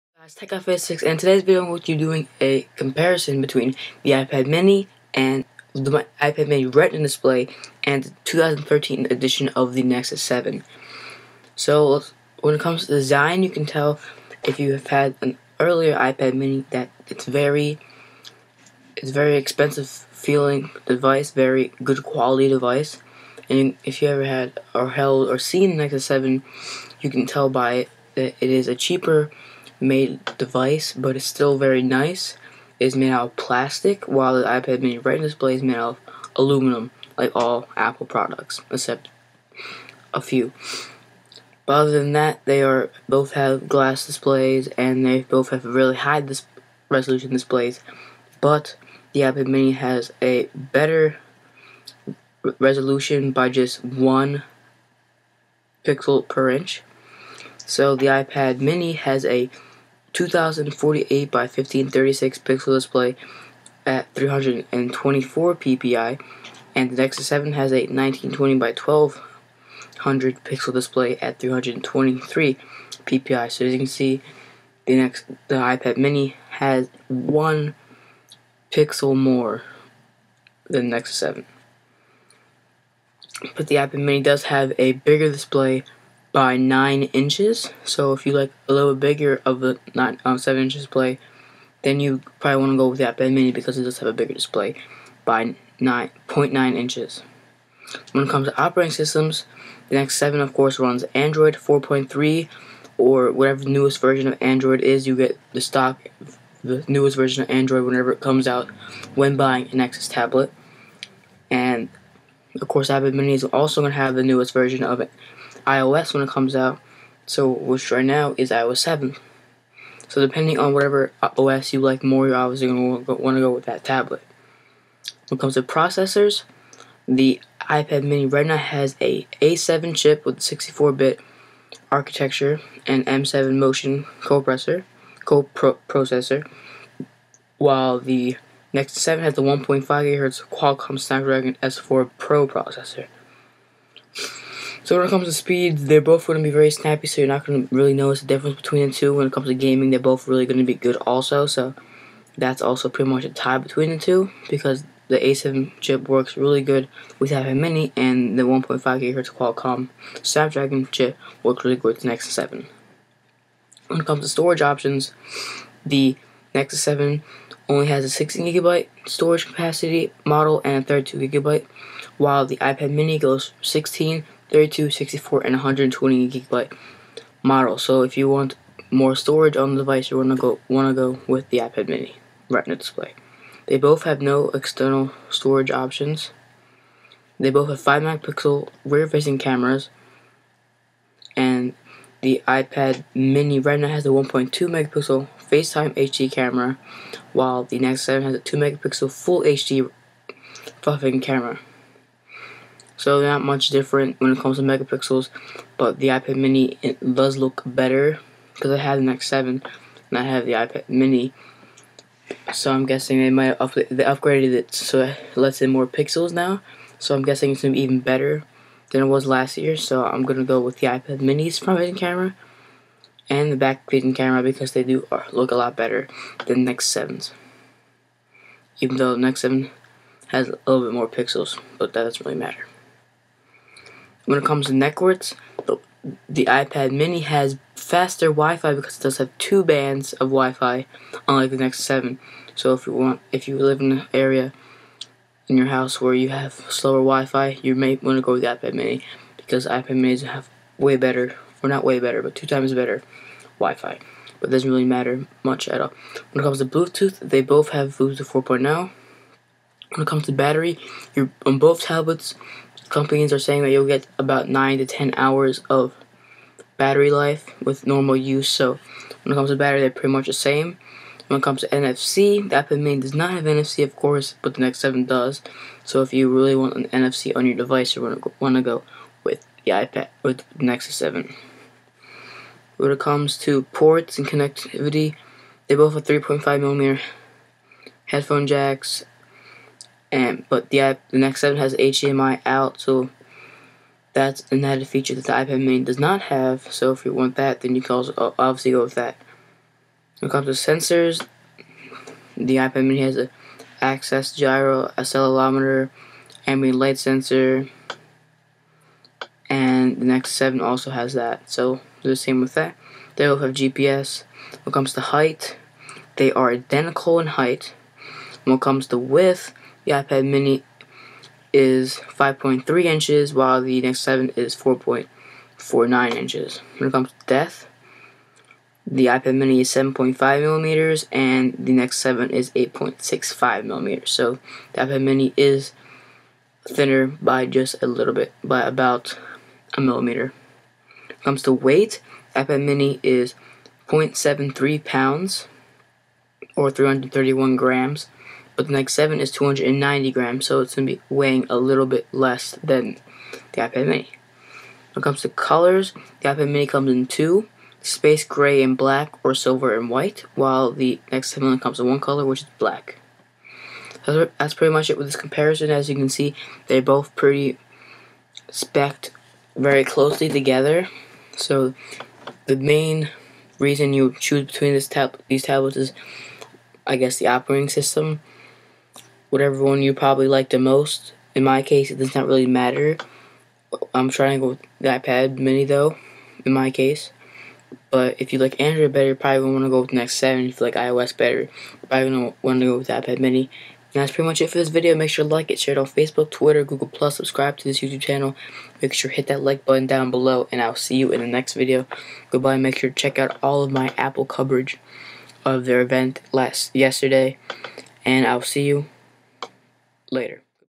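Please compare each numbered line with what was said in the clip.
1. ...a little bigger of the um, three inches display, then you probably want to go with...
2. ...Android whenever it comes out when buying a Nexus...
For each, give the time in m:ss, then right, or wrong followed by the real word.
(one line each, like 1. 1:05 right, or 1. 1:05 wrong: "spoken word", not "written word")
1. 1:28 wrong: "seven", not "three"
2. 1:47 right.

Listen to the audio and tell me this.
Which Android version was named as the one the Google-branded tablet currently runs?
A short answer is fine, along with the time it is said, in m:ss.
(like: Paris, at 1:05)
Android 4.3, at 1:41.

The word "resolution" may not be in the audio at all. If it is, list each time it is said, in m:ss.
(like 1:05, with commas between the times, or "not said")
0:46, 0:52.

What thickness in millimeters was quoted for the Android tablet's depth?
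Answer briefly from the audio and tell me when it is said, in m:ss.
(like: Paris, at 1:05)
8.65 millimeters, at 5:32.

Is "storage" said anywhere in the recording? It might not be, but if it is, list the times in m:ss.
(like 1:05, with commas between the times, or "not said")
2:44, 2:49, 2:59, 3:05.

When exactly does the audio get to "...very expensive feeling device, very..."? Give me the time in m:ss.
0:19.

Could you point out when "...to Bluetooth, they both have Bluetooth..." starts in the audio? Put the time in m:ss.
4:16.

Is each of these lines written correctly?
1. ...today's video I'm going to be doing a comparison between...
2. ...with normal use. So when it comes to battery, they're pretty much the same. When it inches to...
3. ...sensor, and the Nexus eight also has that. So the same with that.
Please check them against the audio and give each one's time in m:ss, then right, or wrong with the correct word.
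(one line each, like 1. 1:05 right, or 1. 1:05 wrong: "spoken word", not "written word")
1. 0:01 right
2. 4:27 wrong: "comes", not "inches"
3. 5:06 wrong: "seven", not "eight".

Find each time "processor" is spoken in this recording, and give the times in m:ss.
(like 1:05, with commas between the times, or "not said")
2:05, 2:14, 2:22.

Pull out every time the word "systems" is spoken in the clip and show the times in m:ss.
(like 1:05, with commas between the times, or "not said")
1:38, 6:17.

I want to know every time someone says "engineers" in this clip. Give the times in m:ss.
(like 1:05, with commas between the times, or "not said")
not said.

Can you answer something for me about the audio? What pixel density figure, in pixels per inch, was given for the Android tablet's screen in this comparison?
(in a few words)
323 ppi.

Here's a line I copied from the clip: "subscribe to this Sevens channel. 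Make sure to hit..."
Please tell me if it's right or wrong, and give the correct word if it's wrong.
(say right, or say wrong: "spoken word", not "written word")
wrong: "YouTube", not "Sevens".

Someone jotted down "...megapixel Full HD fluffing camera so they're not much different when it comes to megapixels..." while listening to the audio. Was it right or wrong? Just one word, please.
right.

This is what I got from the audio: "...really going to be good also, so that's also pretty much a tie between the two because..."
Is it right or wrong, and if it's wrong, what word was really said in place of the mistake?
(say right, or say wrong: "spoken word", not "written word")
right.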